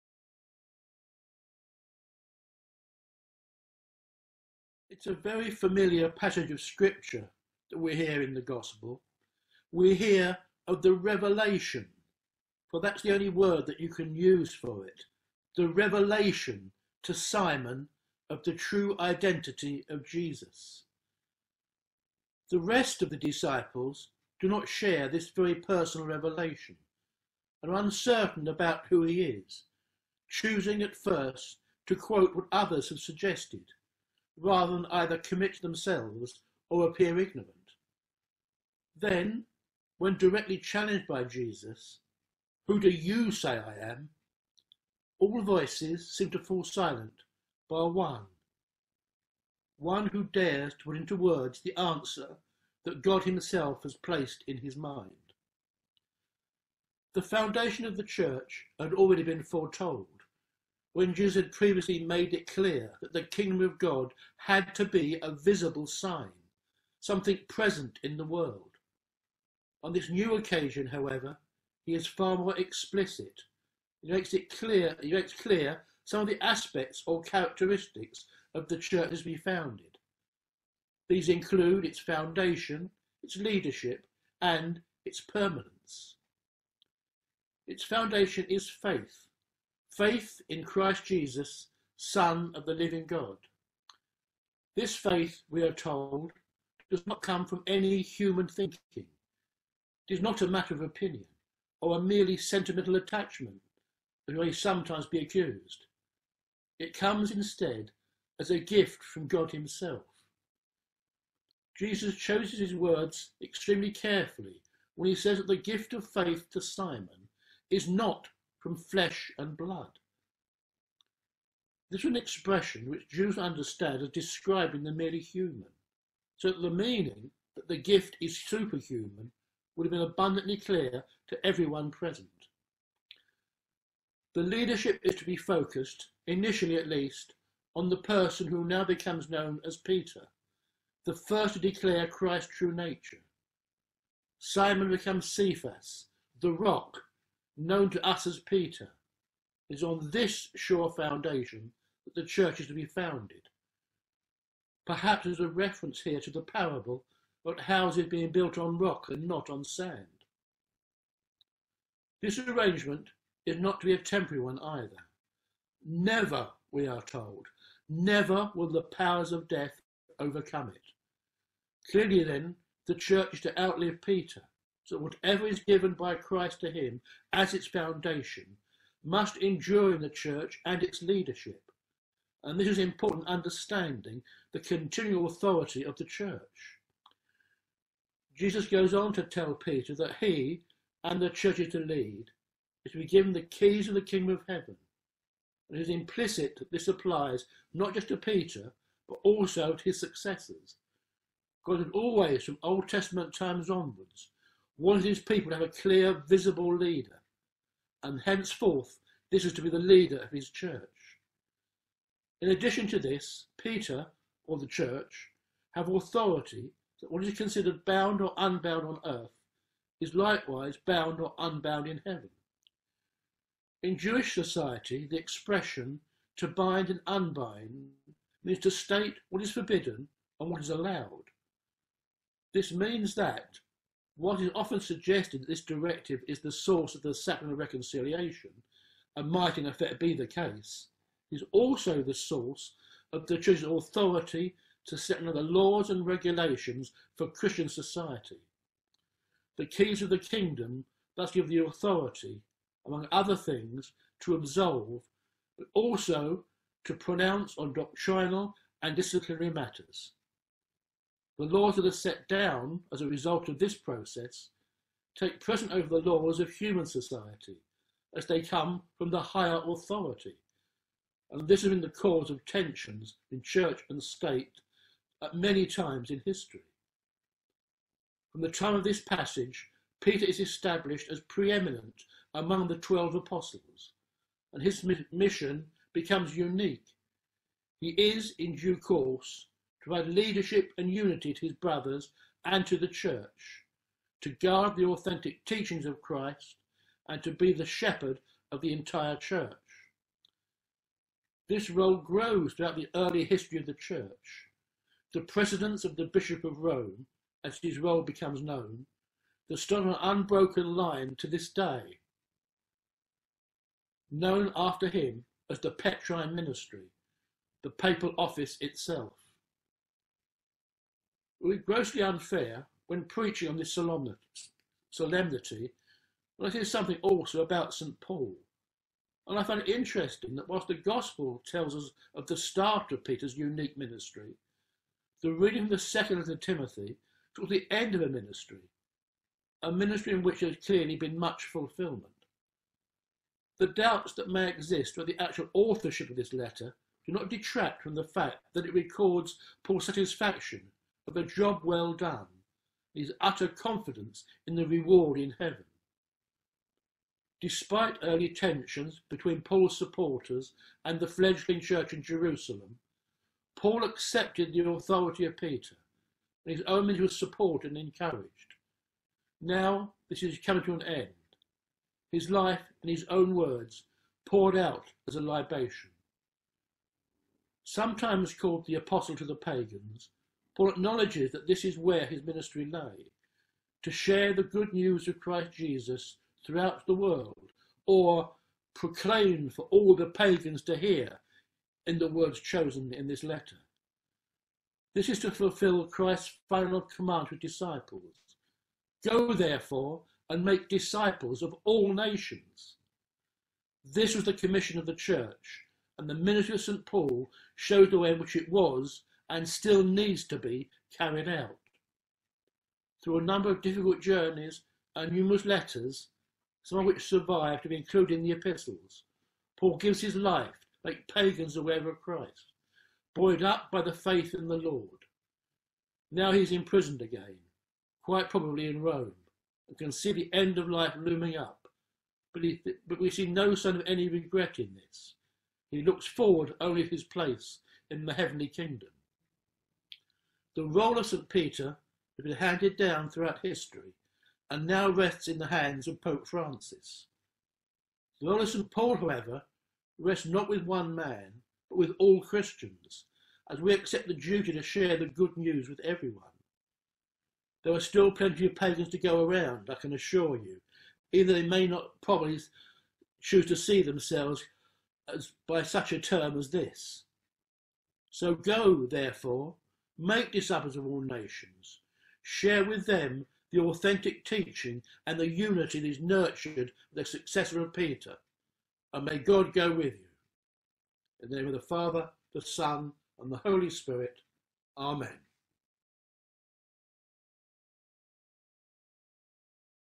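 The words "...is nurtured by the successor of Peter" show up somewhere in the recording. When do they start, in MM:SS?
07:55.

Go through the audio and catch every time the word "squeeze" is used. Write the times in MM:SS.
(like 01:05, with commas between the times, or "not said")
not said.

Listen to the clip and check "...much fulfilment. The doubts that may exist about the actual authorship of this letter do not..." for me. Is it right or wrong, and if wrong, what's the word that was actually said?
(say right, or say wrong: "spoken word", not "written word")
right.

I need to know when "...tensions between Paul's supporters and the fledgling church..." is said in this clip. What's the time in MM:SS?
05:58.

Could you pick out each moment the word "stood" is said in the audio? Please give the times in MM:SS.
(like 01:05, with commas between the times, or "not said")
05:09.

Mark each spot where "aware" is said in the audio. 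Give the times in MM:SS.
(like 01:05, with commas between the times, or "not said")
07:01.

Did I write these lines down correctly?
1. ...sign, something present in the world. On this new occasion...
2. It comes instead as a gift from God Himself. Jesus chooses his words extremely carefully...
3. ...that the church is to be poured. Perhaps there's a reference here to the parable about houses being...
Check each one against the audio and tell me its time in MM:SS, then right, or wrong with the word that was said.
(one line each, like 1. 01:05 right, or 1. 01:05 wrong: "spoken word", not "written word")
1. 01:05 right
2. 01:46 right
3. 02:32 wrong: "founded", not "poured".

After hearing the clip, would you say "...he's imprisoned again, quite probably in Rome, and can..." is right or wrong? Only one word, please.
right.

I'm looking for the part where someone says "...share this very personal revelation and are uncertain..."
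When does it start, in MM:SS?
00:24.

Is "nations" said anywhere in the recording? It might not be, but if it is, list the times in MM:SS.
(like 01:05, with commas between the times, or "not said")
06:41, 07:51.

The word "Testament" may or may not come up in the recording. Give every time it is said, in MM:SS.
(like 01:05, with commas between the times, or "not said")
03:22.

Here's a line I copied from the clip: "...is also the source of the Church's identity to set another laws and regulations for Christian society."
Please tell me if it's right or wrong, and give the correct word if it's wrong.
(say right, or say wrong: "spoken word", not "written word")
wrong: "authority", not "identity".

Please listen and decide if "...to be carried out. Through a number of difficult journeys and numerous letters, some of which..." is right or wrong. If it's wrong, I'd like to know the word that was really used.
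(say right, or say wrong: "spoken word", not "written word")
right.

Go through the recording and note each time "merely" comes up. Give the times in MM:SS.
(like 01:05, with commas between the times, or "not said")
01:42, 02:04.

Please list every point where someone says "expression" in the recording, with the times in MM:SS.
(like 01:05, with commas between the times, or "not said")
02:02, 03:45.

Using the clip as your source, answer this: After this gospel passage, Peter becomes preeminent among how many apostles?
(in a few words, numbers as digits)
12.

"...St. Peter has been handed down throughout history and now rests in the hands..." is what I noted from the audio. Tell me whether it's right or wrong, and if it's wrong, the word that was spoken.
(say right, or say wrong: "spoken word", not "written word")
right.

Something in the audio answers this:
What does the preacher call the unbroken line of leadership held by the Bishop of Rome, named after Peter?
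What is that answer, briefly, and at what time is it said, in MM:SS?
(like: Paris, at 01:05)
Petrine Ministry, at 05:15.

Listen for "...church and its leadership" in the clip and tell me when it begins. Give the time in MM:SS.
03:00.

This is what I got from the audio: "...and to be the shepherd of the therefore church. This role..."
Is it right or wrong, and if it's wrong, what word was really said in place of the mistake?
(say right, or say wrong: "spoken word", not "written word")
wrong: "entire", not "therefore".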